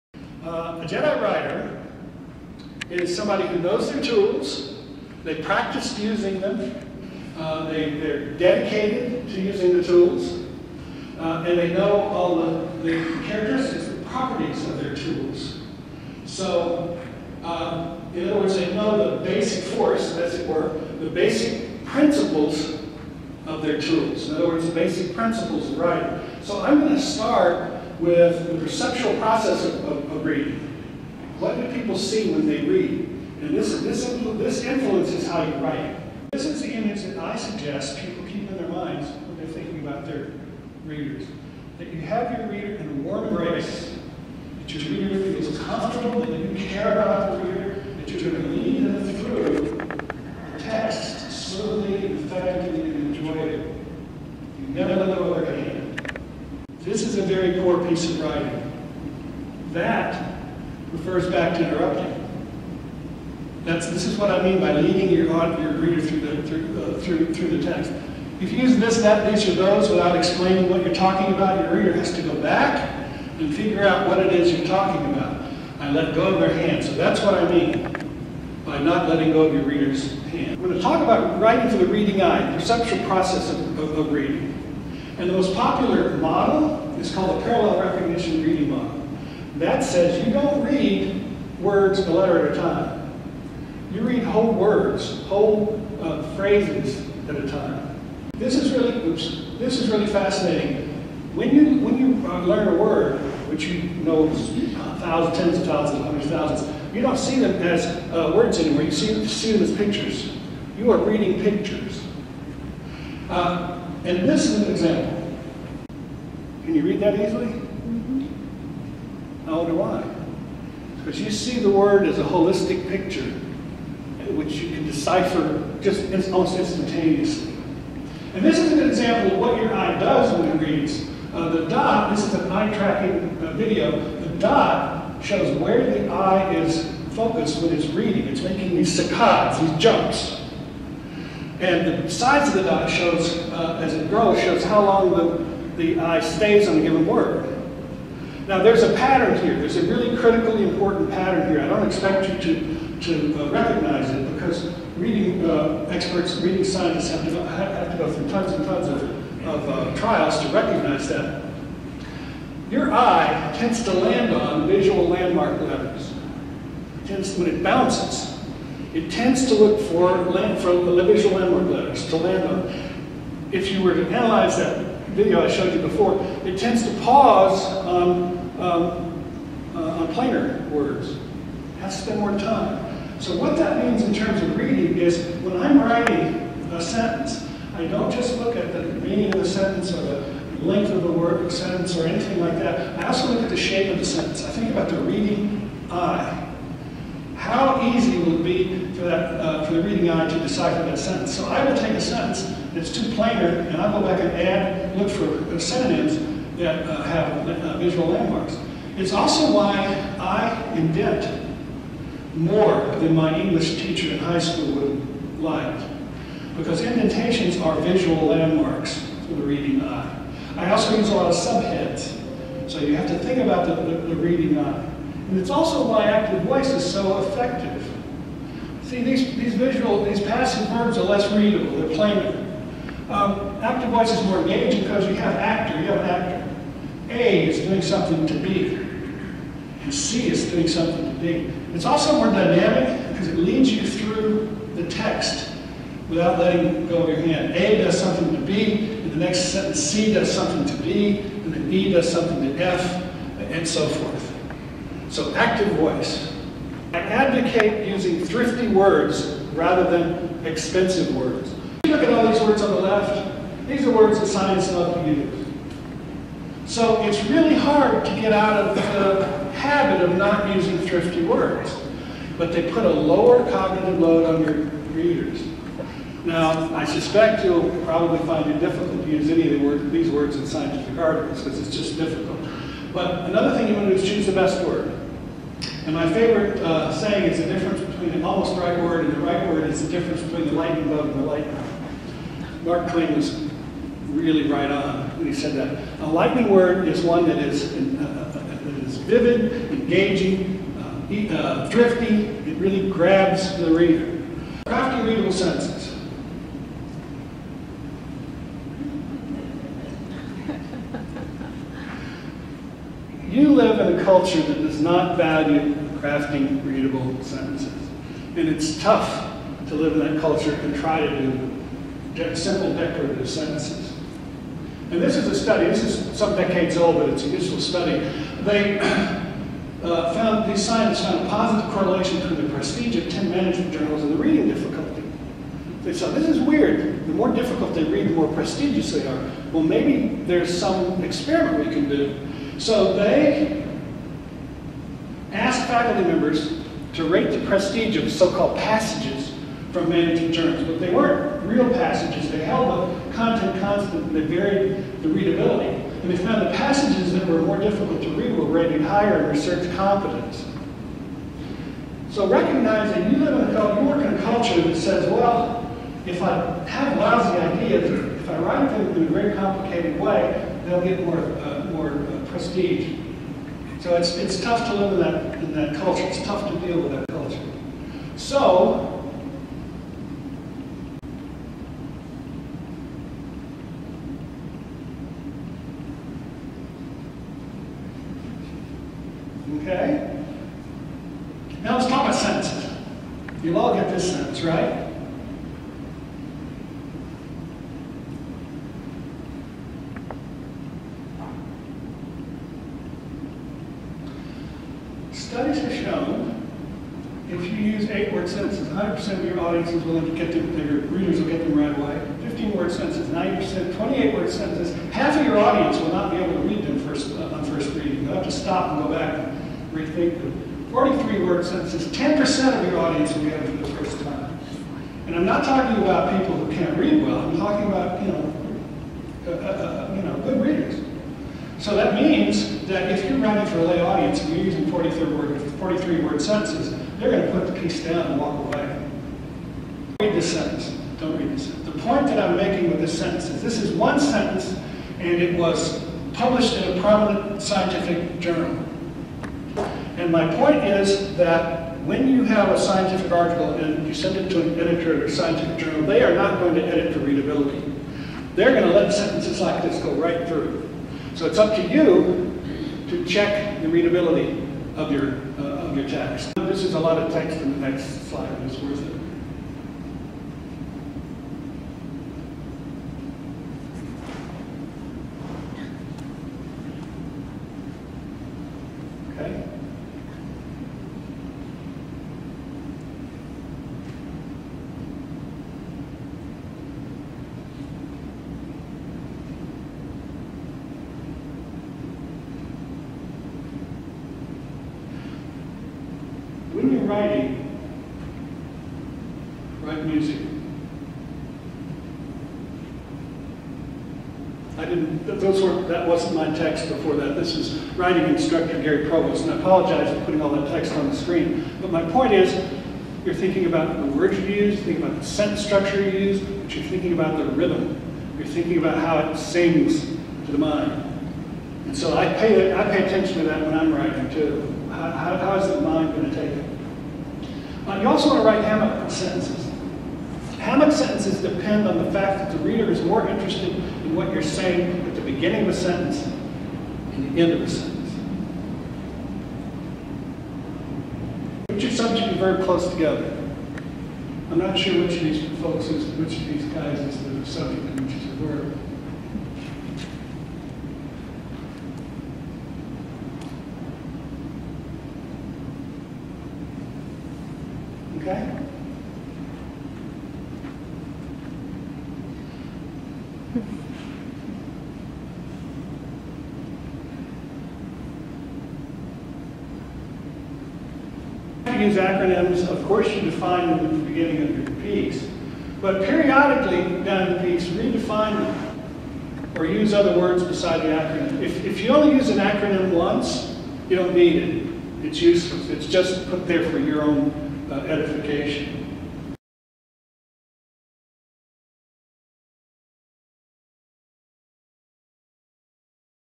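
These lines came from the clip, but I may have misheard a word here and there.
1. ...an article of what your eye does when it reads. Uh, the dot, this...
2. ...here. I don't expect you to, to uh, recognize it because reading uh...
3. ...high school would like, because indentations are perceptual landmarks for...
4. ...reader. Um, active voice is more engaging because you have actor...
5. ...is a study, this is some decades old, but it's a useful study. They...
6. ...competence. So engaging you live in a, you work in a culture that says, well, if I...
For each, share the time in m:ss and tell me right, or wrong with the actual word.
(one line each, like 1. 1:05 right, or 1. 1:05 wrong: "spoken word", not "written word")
1. 2:08 wrong: "example", not "article"
2. 2:31 right
3. 3:34 wrong: "visual", not "perceptual"
4. 3:51 wrong: "plainer", not "reader"
5. 5:25 right
6. 5:59 wrong: "recognizing", not "engaging".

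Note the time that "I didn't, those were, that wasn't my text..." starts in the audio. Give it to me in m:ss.
8:24.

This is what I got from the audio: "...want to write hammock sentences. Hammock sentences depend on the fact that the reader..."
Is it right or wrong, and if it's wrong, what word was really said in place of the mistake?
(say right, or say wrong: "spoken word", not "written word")
right.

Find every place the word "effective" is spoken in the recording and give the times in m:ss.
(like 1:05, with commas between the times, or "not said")
3:47.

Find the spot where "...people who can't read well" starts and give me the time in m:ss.
7:06.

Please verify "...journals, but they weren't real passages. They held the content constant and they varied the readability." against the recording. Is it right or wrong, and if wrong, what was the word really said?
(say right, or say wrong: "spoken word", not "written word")
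right.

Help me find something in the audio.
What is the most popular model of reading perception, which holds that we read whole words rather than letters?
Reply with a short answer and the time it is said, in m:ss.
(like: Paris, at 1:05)
Parallel recognition reading model, at 1:27.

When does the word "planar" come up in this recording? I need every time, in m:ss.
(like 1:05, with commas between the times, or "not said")
3:00, 3:23.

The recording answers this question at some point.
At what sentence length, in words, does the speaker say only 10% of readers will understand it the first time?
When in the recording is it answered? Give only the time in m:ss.
7:00.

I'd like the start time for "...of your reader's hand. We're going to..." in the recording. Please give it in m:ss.
1:19.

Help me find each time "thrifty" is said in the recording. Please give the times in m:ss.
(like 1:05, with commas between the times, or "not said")
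4:18, 4:30, 5:01.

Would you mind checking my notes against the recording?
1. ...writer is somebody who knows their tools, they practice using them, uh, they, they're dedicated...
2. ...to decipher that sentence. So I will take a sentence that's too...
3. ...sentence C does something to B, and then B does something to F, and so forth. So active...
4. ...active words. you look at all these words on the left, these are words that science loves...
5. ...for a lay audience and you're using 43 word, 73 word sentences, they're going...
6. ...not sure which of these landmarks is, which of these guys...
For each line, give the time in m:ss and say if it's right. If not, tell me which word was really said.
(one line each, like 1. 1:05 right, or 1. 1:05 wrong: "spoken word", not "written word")
1. 0:01 right
2. 3:20 right
3. 4:09 right
4. 4:20 wrong: "expensive", not "active"
5. 7:13 wrong: "43", not "73"
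6. 9:04 wrong: "folks", not "landmarks".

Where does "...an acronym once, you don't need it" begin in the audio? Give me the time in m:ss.
9:42.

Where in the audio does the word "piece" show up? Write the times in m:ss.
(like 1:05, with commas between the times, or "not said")
0:57, 7:17.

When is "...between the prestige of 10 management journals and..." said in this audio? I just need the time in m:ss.
5:32.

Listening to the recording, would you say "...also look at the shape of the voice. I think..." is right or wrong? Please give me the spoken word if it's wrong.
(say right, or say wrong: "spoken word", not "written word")
wrong: "sentence", not "voice".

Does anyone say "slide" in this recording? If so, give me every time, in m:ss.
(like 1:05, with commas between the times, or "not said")
7:48.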